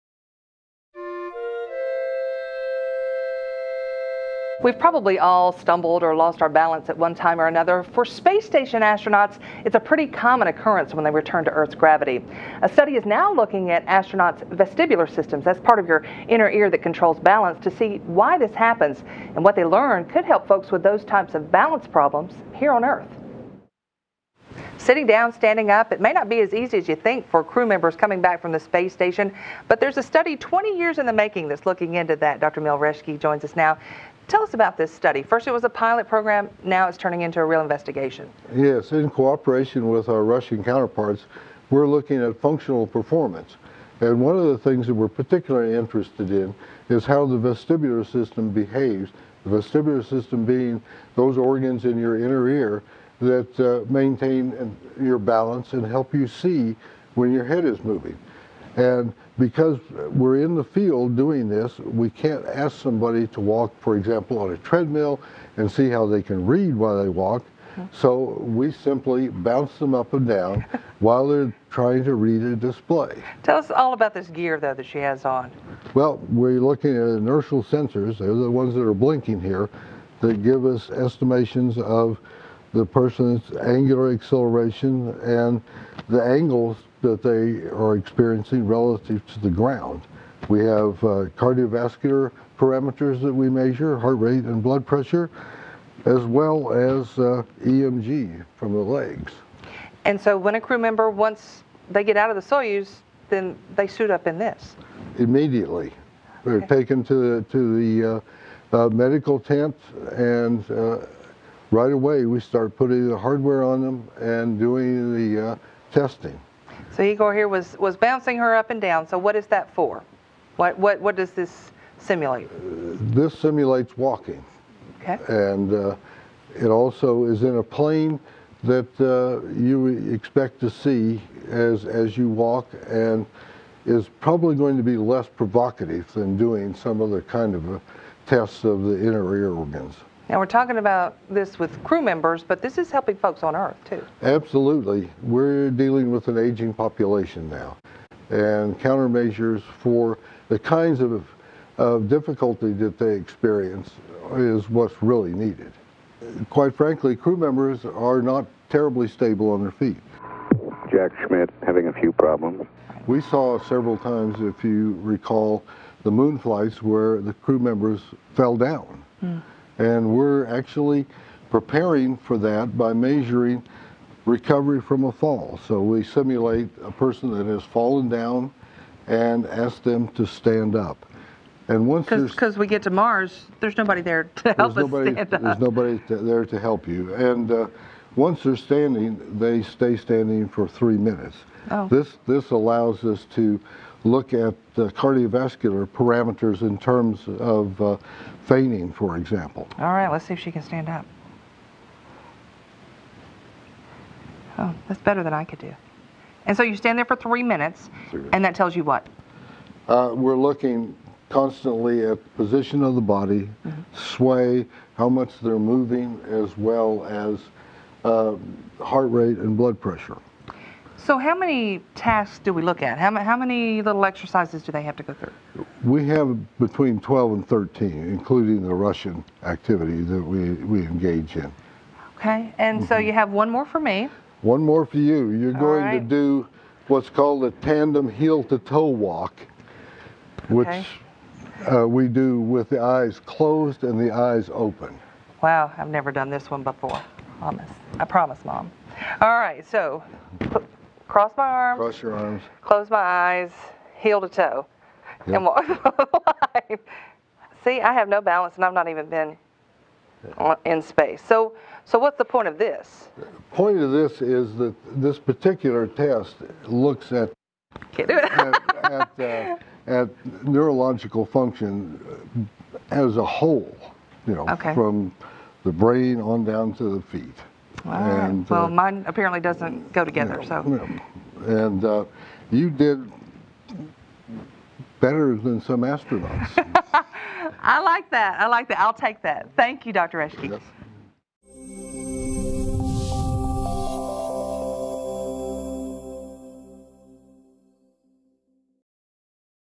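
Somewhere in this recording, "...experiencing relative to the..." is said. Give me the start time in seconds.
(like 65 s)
87 s.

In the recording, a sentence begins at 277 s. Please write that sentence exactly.
And, well, uh, mine apparently doesn't go together.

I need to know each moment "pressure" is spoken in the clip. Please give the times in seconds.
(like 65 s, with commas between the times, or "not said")
94 s, 219 s.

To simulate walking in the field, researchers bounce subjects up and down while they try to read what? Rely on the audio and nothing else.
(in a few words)
A display.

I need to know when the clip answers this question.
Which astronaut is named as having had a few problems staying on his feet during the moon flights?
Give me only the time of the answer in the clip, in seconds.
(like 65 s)
160 s.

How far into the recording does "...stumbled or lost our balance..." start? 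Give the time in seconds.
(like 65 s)
5 s.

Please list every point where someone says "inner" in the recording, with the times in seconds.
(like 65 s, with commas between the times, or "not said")
16 s, 52 s, 138 s.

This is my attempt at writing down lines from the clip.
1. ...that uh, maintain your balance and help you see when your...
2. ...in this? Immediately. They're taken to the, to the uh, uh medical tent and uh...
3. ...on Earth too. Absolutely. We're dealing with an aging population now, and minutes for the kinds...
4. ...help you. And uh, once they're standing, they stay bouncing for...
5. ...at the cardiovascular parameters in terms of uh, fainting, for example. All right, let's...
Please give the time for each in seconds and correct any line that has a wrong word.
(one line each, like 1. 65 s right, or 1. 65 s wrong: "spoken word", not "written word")
1. 53 s right
2. 104 s right
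3. 143 s wrong: "countermeasures", not "minutes"
4. 186 s wrong: "standing", not "bouncing"
5. 194 s right.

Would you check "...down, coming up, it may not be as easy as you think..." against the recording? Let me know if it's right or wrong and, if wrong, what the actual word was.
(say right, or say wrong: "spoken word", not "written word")
wrong: "standing", not "coming".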